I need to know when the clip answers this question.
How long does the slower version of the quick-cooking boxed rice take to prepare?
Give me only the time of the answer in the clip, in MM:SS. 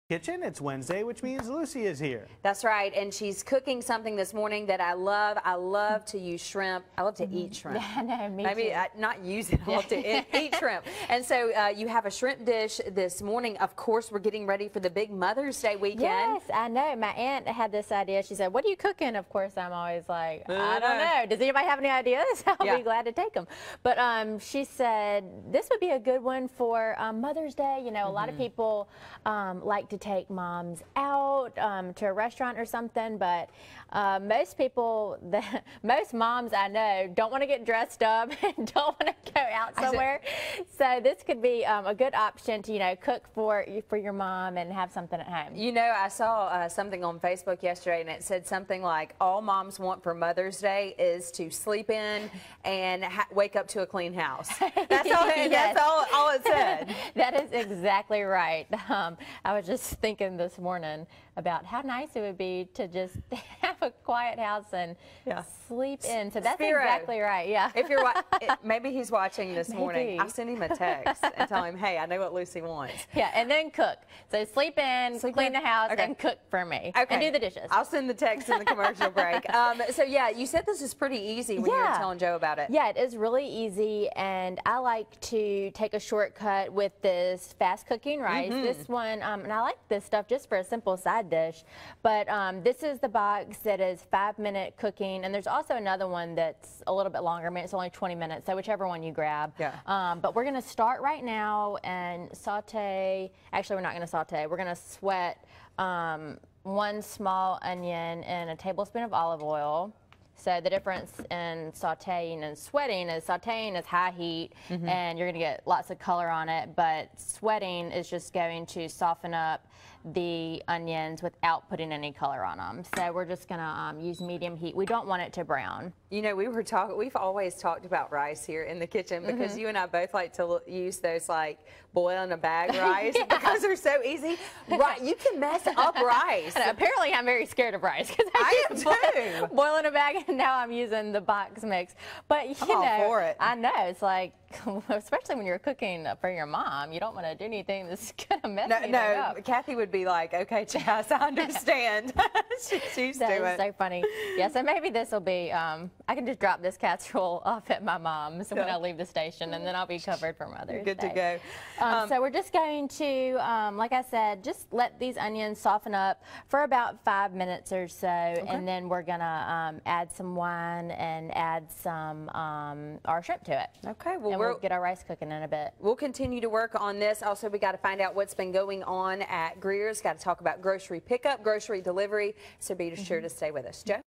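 01:37.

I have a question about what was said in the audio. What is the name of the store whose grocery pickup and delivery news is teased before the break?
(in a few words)
Greer's.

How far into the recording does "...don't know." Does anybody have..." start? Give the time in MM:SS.
00:20.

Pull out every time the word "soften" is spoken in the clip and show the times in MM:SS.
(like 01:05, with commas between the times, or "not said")
01:58, 02:45.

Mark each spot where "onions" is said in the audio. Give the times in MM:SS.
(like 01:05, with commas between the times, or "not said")
01:47, 02:00, 02:45.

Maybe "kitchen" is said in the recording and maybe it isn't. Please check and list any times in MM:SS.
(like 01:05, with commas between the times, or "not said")
00:00, 02:08.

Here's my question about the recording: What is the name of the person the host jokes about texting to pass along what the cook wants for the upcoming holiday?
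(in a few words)
Spiro.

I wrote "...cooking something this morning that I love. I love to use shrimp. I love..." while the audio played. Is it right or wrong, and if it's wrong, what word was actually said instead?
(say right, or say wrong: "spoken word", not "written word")
right.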